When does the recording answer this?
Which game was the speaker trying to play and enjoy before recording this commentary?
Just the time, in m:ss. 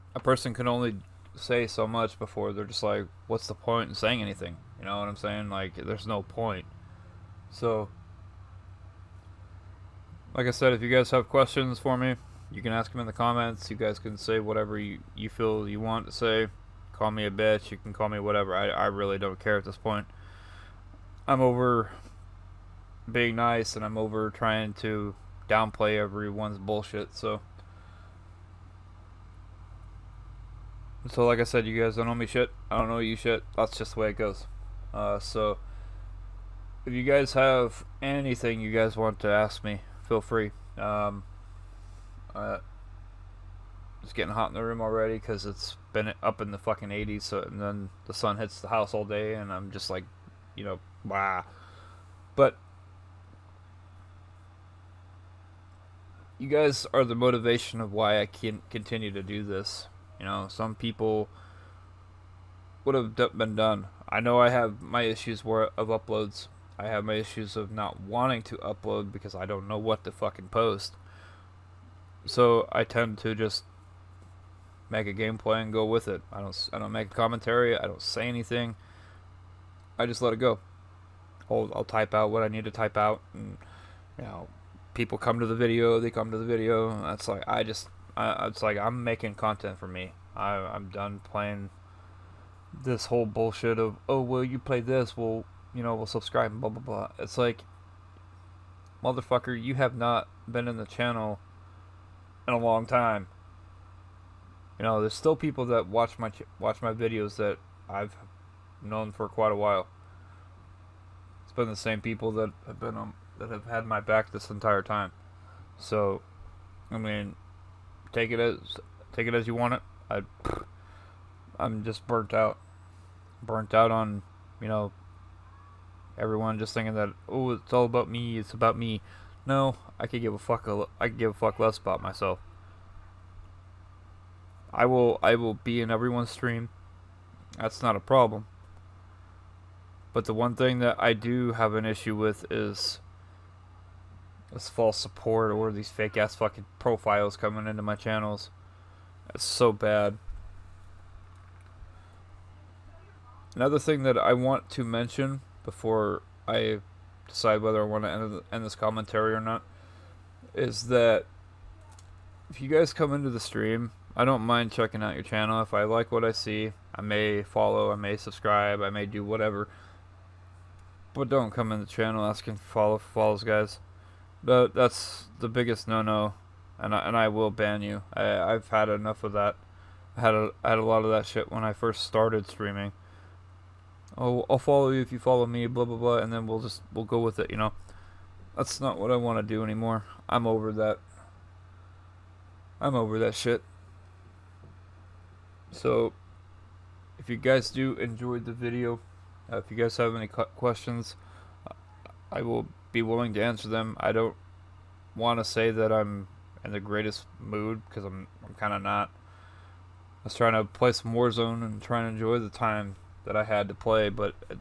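3:31.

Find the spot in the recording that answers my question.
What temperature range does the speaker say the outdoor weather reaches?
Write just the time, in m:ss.
0:46.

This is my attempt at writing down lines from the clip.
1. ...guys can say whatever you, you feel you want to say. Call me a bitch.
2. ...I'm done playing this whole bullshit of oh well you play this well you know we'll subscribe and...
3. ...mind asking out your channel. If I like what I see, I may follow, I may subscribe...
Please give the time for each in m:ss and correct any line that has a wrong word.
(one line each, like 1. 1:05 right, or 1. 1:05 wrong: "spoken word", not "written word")
1. 0:13 right
2. 1:30 right
3. 2:44 wrong: "checking", not "asking".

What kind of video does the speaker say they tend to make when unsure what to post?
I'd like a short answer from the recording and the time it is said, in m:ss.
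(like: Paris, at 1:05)
Gameplay, at 1:15.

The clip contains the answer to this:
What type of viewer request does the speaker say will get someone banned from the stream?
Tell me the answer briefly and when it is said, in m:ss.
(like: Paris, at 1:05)
Follow for follows, at 2:52.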